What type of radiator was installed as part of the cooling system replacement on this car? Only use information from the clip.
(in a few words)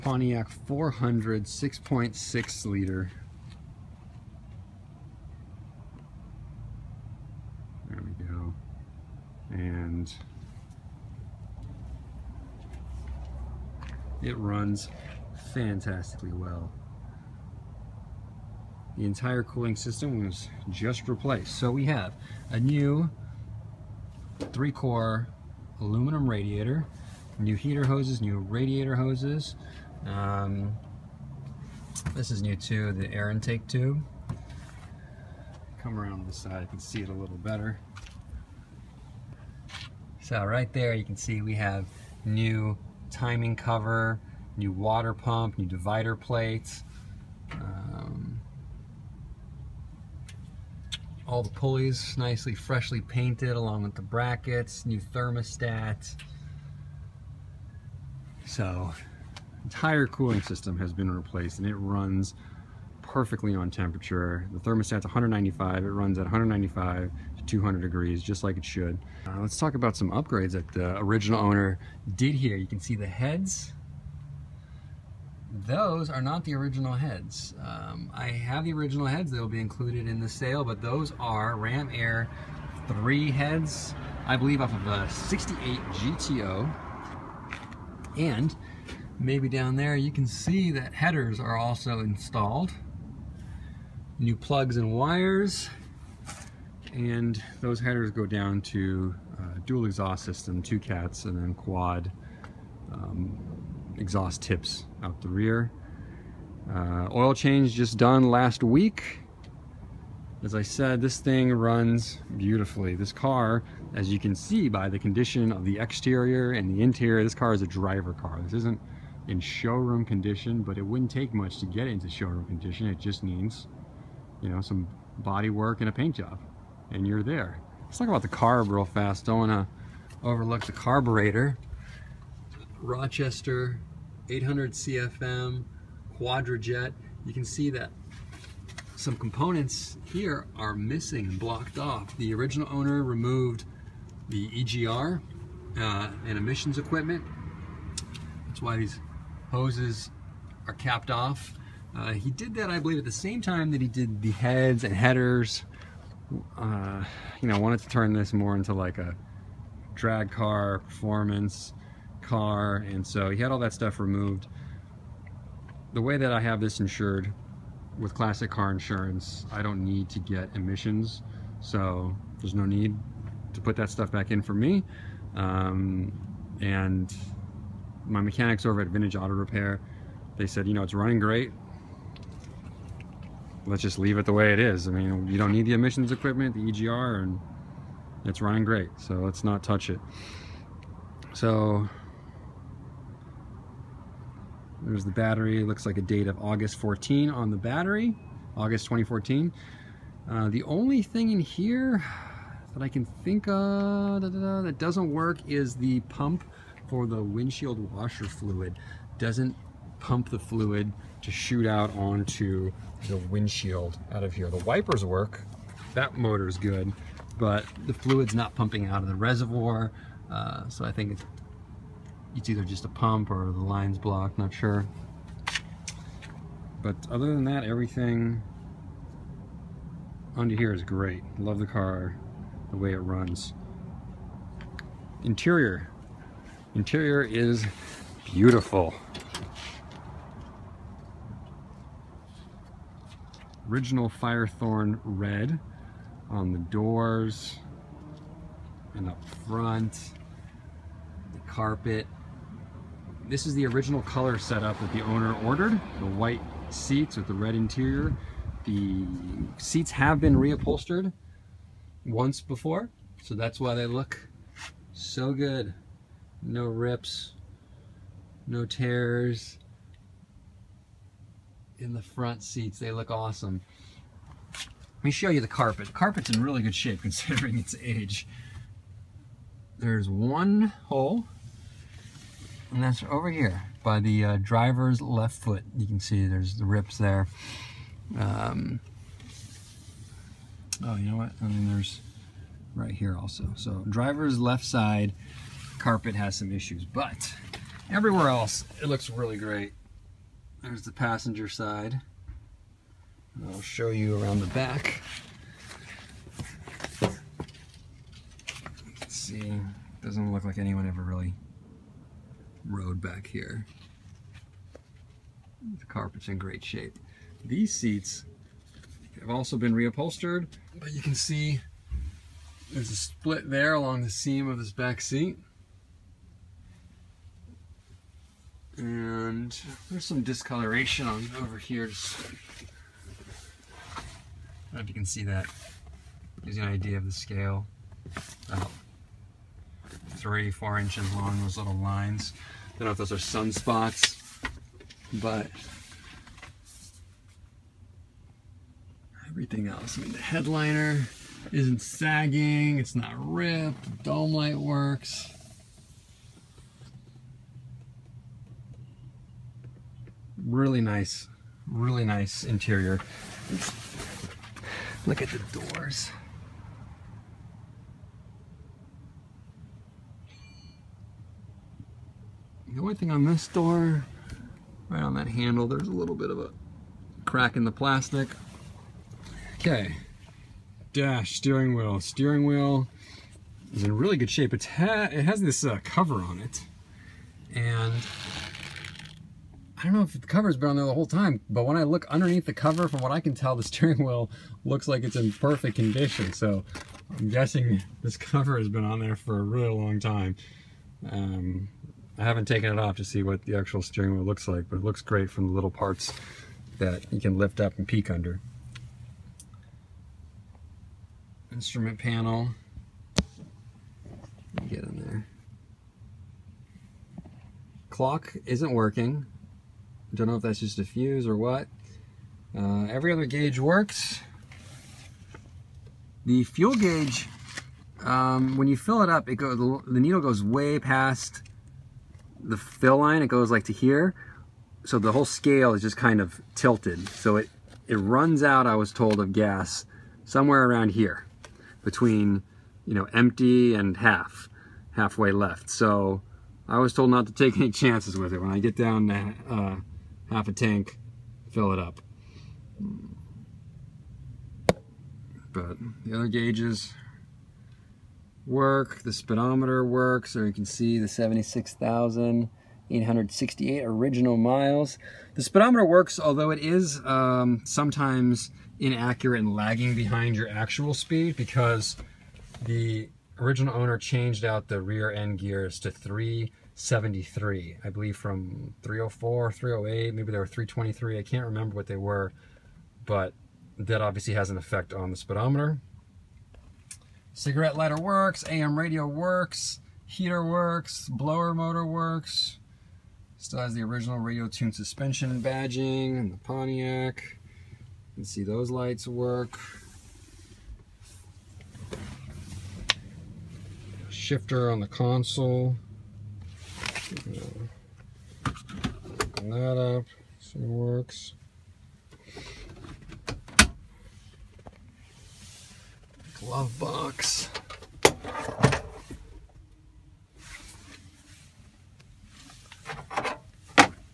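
Three core aluminum.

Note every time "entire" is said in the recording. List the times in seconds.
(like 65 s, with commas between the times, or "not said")
19 s, 59 s.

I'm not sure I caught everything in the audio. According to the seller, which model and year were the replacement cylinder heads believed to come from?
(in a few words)
68 GTO.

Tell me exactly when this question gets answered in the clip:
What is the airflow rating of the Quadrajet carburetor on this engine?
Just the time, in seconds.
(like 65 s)
134 s.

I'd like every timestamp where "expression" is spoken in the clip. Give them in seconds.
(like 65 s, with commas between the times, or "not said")
not said.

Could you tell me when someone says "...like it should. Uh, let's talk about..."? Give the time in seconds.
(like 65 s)
68 s.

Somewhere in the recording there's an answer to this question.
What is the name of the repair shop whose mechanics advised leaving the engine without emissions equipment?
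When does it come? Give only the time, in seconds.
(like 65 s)
178 s.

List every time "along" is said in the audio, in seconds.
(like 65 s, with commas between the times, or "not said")
53 s, 323 s.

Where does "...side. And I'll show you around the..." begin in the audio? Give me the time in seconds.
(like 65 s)
301 s.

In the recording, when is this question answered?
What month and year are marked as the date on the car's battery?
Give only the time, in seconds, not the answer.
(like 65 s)
198 s.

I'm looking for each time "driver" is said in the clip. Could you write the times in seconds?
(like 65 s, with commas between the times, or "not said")
117 s, 284 s, 293 s.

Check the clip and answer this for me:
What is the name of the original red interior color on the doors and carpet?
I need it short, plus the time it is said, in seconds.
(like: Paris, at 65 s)
Firethorn red, at 244 s.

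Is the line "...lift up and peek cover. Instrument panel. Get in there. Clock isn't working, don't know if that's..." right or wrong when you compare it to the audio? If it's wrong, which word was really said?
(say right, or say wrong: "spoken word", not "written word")
wrong: "under", not "cover".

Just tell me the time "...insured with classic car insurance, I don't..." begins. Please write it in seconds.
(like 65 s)
166 s.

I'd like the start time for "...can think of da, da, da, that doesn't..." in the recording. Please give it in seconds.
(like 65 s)
202 s.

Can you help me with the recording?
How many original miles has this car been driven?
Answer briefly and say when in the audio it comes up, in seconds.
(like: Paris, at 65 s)
76,868, at 461 s.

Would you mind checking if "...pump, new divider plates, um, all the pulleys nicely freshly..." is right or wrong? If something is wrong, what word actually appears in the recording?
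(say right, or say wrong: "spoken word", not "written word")
right.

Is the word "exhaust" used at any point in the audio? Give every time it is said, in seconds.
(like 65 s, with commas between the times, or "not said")
99 s, 103 s.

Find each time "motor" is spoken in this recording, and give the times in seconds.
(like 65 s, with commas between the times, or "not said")
216 s, 491 s.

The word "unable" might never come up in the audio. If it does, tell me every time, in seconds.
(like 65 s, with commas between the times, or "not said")
not said.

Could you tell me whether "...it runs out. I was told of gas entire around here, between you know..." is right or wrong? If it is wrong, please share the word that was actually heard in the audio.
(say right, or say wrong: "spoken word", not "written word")
wrong: "somewhere", not "entire".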